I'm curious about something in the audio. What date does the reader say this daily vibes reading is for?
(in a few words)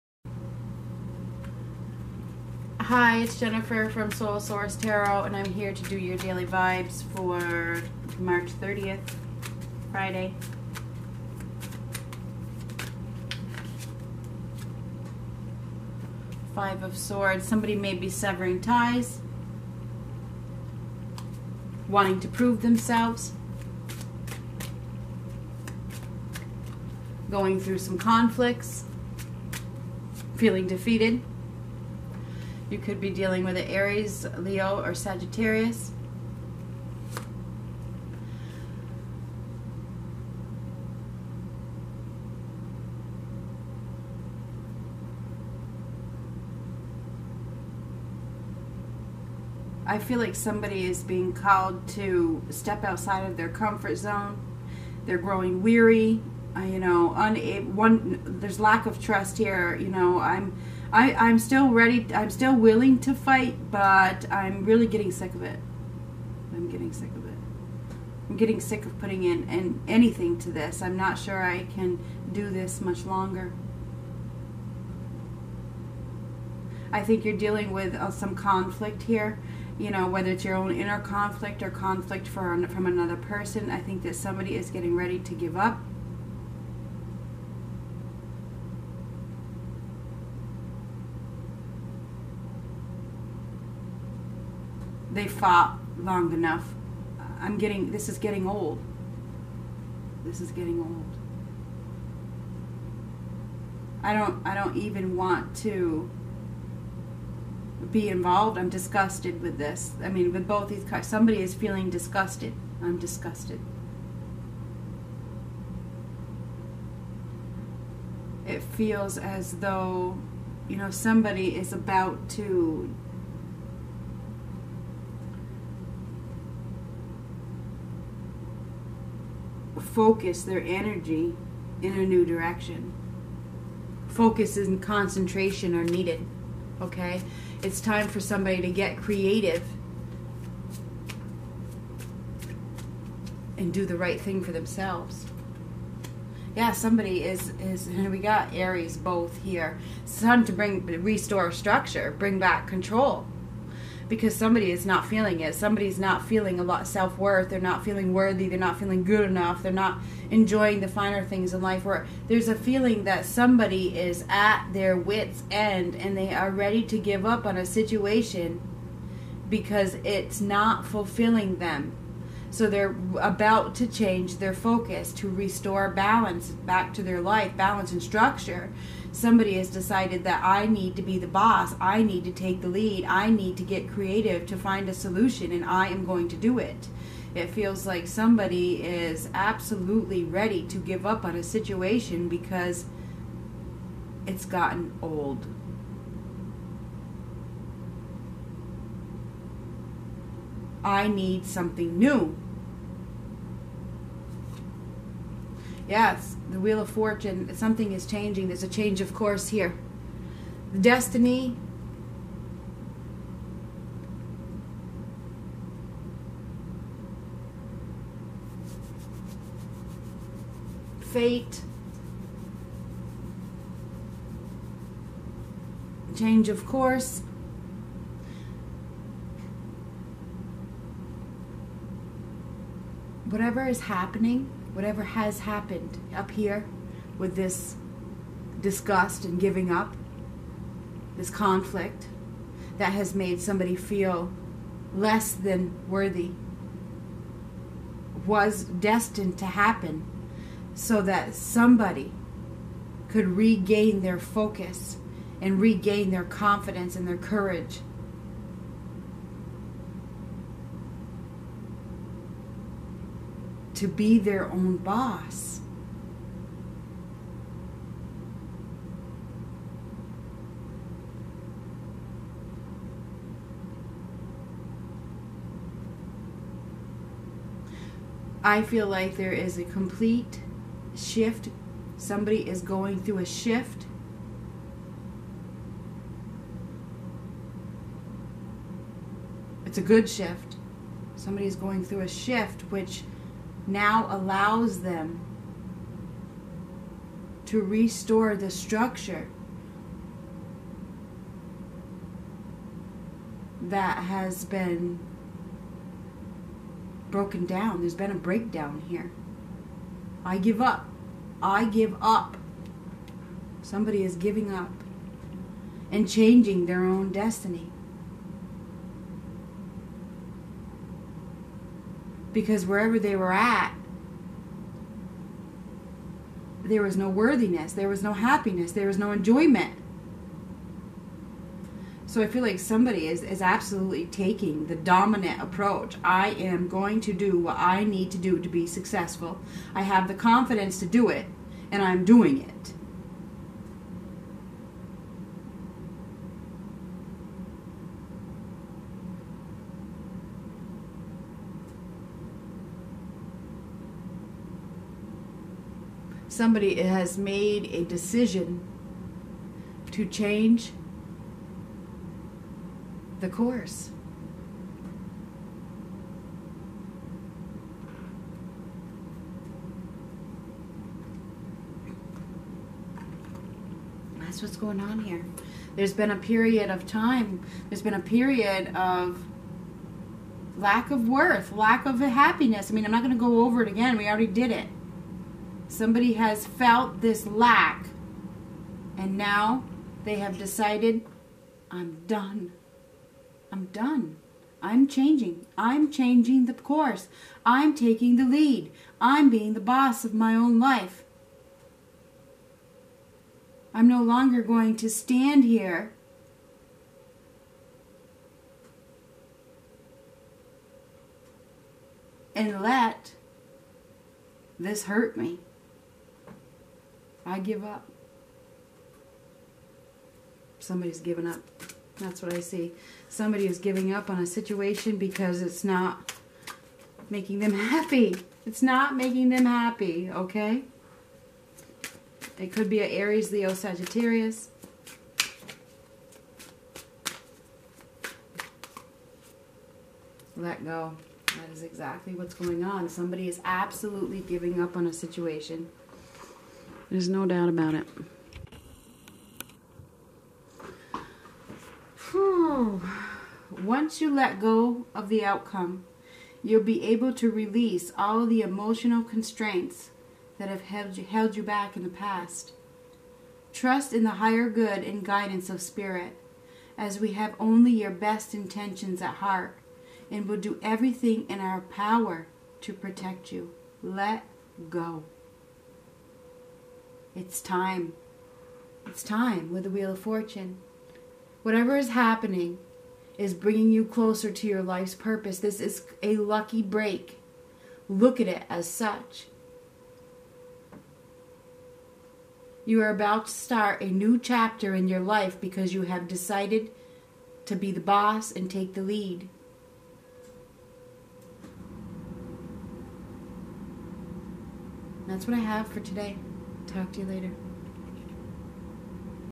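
March 30th.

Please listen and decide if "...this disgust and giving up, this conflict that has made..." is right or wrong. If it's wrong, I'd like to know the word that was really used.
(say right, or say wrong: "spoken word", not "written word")
right.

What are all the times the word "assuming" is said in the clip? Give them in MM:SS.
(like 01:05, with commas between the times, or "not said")
not said.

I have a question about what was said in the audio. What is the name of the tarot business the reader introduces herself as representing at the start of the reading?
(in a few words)
Soul Source Tarot.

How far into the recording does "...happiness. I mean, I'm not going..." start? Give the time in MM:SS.
06:21.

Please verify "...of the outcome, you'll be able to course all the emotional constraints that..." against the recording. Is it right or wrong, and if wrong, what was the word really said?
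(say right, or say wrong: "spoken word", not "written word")
wrong: "release", not "course".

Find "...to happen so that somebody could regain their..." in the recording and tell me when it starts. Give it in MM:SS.
04:09.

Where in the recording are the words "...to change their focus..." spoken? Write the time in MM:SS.
02:53.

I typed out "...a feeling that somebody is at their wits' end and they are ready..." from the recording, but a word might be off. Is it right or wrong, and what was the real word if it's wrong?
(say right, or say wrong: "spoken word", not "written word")
right.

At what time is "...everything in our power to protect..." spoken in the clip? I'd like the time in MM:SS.
07:50.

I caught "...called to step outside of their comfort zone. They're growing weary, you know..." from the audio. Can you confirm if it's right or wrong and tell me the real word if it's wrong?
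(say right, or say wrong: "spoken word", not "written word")
right.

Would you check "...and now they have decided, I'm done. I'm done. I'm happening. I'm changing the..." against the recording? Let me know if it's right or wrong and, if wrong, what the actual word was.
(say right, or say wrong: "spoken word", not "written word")
wrong: "changing", not "happening".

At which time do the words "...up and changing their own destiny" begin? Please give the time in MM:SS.
05:14.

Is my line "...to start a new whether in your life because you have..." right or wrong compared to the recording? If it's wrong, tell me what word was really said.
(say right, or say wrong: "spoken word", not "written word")
wrong: "chapter", not "whether".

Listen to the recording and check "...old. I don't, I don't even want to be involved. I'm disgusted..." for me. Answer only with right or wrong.
right.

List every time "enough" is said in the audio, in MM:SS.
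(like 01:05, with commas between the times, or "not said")
01:36, 02:39.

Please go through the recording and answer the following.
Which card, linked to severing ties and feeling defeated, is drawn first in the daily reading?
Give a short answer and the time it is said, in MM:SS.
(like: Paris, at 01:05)
Five of Swords, at 00:16.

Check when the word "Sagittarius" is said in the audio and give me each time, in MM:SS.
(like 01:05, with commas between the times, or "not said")
00:34, 07:13.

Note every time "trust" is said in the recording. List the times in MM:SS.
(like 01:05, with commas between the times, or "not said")
00:59, 07:43.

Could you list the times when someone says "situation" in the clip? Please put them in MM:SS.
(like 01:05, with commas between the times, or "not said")
02:47, 03:11, 07:04, 07:24.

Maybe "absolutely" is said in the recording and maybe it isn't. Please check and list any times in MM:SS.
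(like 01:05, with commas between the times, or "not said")
03:09, 05:33, 07:23.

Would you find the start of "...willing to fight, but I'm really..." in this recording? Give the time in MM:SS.
01:02.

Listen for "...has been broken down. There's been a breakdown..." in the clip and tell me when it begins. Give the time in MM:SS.
05:03.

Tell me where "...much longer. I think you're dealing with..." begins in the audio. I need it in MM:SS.
01:12.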